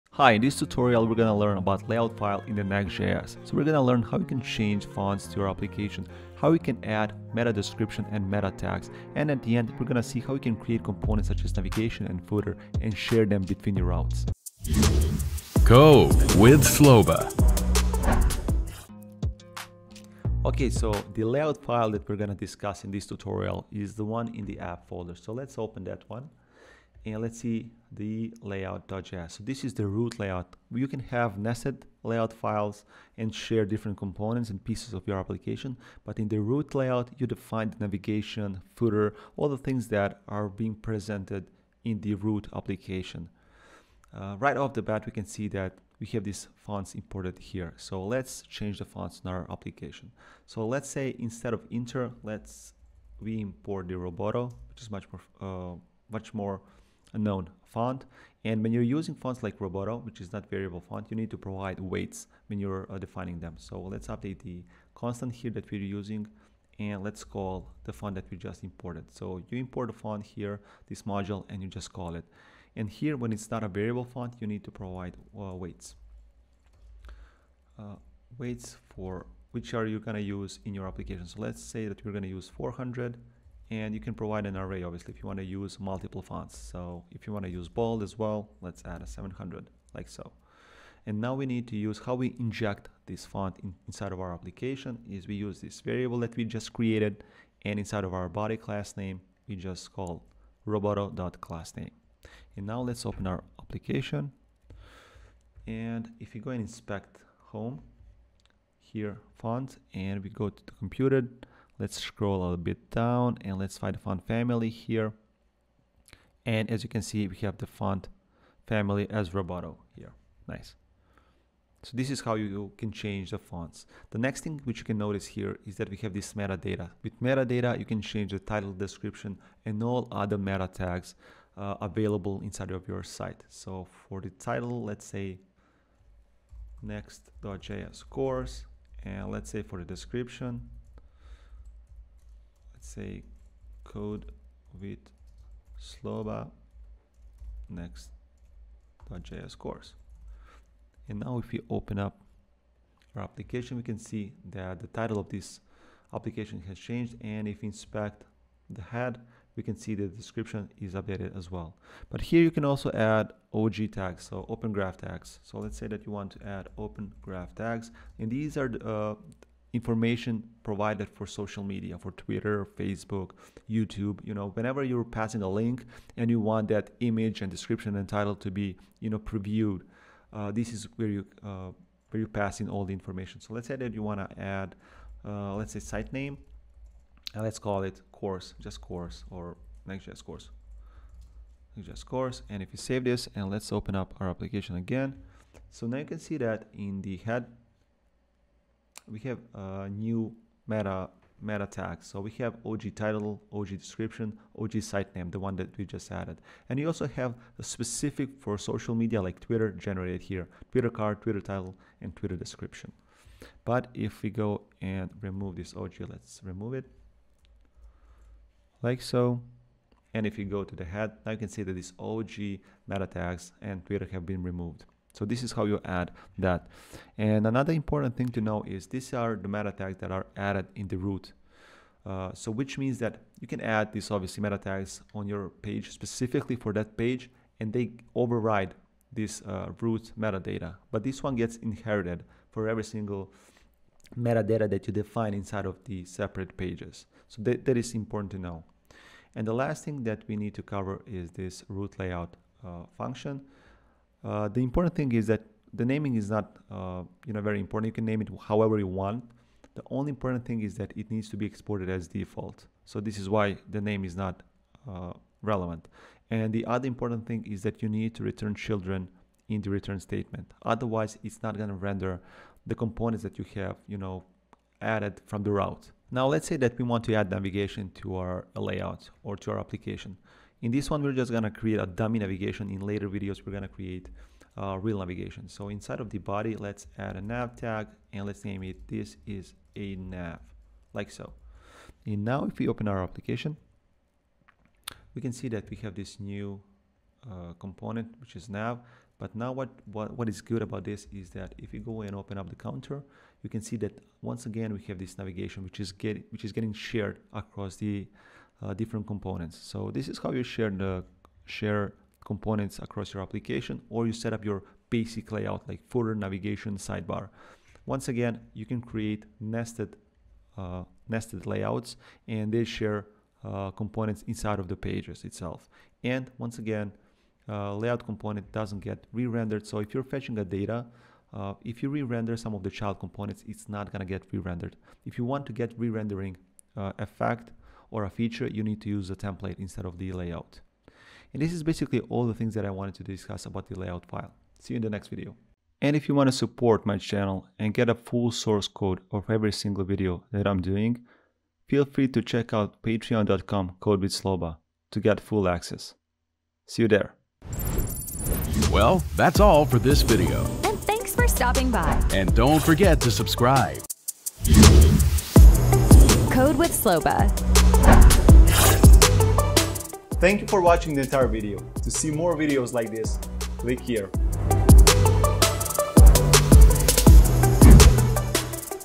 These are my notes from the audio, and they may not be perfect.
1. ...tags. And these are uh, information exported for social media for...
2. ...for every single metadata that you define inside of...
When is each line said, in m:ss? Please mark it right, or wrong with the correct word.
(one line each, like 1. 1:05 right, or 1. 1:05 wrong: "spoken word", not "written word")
1. 2:47 wrong: "provided", not "exported"
2. 4:02 right.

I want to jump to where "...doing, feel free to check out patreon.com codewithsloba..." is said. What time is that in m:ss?
5:50.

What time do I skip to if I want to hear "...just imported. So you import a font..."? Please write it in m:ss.
1:08.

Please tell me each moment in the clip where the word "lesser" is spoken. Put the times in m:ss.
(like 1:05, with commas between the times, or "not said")
not said.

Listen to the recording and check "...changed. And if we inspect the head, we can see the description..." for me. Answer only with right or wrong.
right.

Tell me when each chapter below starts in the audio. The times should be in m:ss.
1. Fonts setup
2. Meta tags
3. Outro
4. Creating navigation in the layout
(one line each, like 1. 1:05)
1. 0:45
2. 2:04
3. 5:45
4. 4:10.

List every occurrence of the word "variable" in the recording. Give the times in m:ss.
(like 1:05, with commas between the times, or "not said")
1:00, 1:13, 1:35.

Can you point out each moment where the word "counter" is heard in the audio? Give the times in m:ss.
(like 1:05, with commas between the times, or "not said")
5:02.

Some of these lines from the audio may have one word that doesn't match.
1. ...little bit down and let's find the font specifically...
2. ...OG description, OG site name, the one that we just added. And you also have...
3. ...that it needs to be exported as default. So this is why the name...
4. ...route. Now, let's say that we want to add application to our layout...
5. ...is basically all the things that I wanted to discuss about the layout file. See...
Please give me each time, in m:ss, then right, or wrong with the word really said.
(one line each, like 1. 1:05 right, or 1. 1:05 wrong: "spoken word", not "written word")
1. 1:52 wrong: "family", not "specifically"
2. 3:23 right
3. 4:20 right
4. 4:35 wrong: "navigation", not "application"
5. 5:41 right.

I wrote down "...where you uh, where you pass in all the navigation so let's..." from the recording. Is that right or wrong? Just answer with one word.
wrong.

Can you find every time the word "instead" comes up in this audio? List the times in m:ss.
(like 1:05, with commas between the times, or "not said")
0:51, 5:39.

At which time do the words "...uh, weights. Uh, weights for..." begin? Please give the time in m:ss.
1:15.